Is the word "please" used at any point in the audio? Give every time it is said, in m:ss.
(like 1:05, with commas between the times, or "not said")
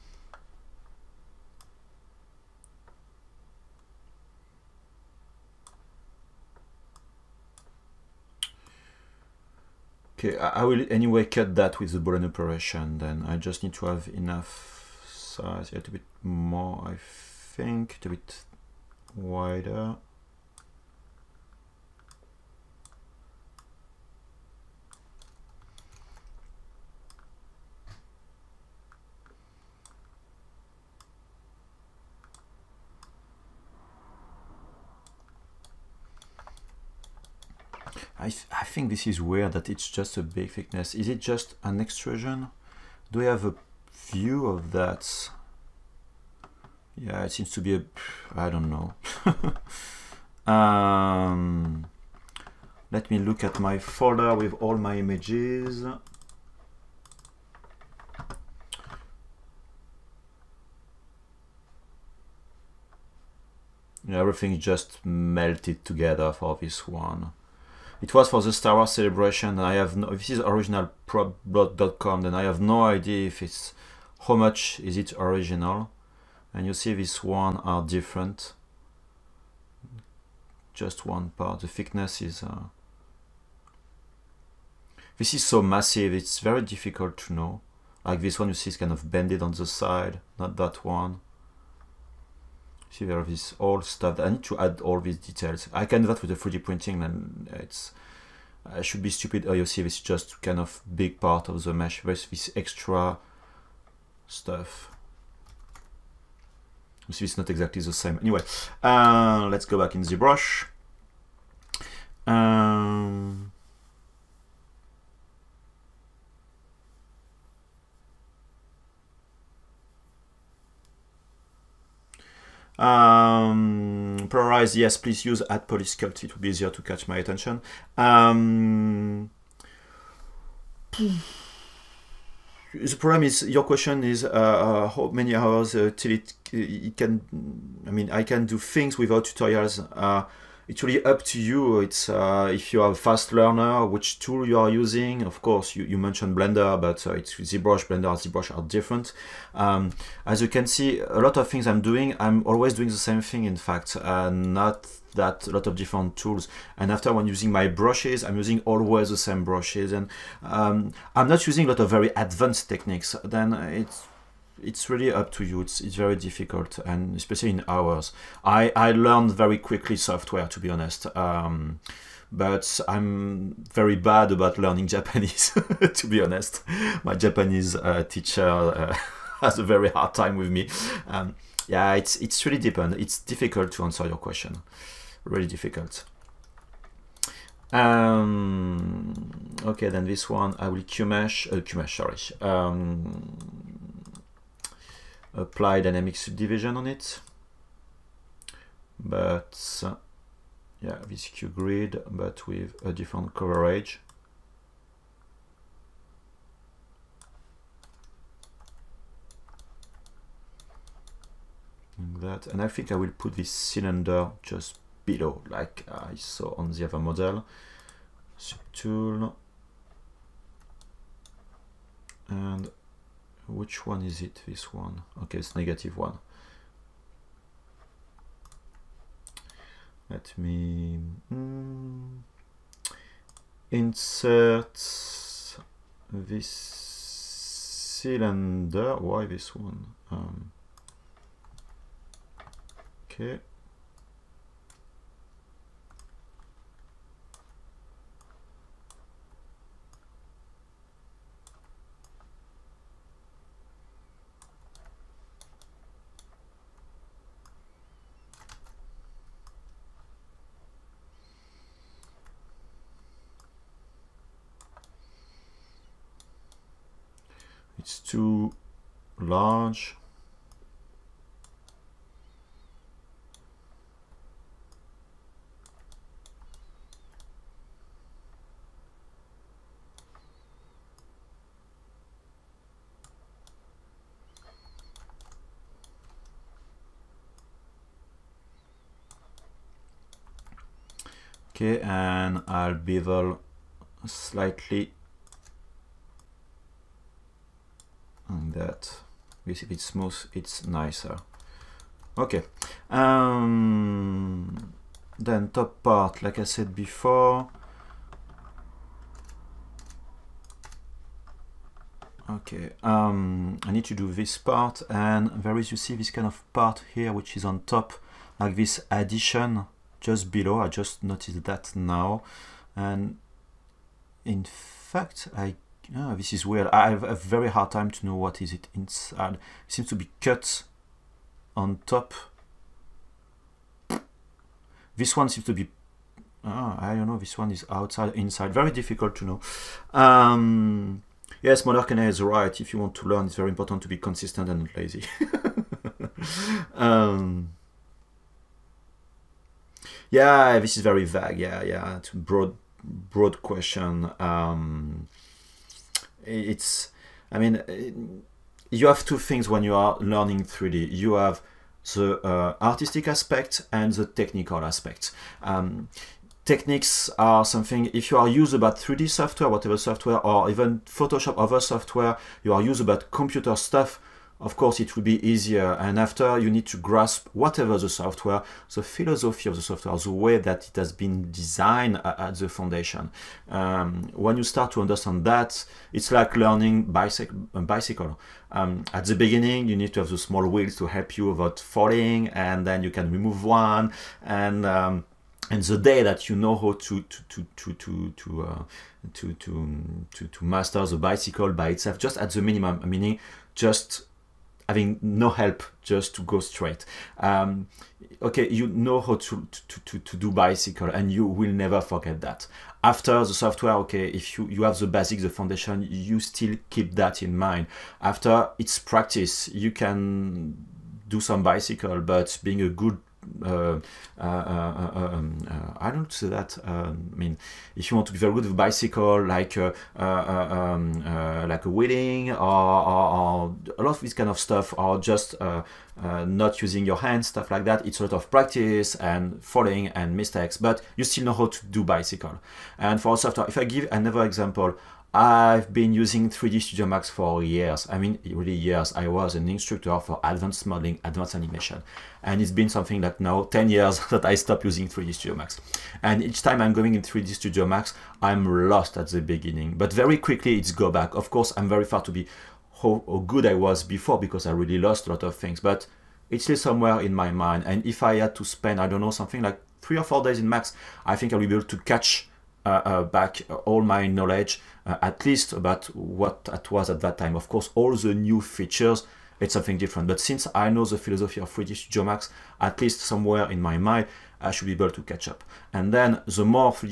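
2:04.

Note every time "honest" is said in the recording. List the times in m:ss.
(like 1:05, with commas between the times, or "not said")
2:50, 2:56.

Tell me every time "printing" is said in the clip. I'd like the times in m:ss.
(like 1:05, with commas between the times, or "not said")
1:36.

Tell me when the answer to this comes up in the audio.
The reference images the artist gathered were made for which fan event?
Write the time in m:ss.
1:08.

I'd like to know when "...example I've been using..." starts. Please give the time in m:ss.
7:24.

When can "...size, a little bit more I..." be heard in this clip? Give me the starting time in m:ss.
0:15.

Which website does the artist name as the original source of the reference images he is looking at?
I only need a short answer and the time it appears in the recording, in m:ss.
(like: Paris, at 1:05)
propblood.com, at 1:11.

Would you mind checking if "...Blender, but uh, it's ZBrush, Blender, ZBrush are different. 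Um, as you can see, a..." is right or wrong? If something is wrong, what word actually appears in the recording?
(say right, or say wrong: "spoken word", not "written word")
right.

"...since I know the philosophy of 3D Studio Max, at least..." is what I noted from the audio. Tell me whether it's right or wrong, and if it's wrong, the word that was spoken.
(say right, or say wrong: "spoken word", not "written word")
right.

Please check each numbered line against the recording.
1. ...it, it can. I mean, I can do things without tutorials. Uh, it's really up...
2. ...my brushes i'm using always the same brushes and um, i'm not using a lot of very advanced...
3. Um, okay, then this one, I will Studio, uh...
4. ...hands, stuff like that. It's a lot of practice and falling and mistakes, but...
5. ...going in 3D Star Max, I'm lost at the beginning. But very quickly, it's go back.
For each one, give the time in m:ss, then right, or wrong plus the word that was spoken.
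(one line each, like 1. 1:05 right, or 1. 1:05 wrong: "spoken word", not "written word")
1. 2:16 right
2. 2:37 right
3. 3:07 wrong: "Qmesh", not "Studio"
4. 7:16 right
5. 7:36 wrong: "Studio", not "Star".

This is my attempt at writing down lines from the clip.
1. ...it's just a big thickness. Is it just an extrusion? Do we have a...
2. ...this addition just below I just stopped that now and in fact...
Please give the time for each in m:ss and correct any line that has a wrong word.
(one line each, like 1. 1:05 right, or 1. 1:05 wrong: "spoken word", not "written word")
1. 0:39 right
2. 5:18 wrong: "noticed", not "stopped".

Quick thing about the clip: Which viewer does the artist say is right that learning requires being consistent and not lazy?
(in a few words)
Monarchene.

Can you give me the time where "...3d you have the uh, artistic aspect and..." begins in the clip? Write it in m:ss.
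6:00.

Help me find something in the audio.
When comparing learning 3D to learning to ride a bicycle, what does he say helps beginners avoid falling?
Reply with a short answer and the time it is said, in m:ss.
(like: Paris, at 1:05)
small wheels, at 6:30.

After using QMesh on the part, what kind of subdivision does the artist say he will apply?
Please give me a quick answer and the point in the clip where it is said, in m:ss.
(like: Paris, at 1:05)
Dynamic subdivision, at 3:15.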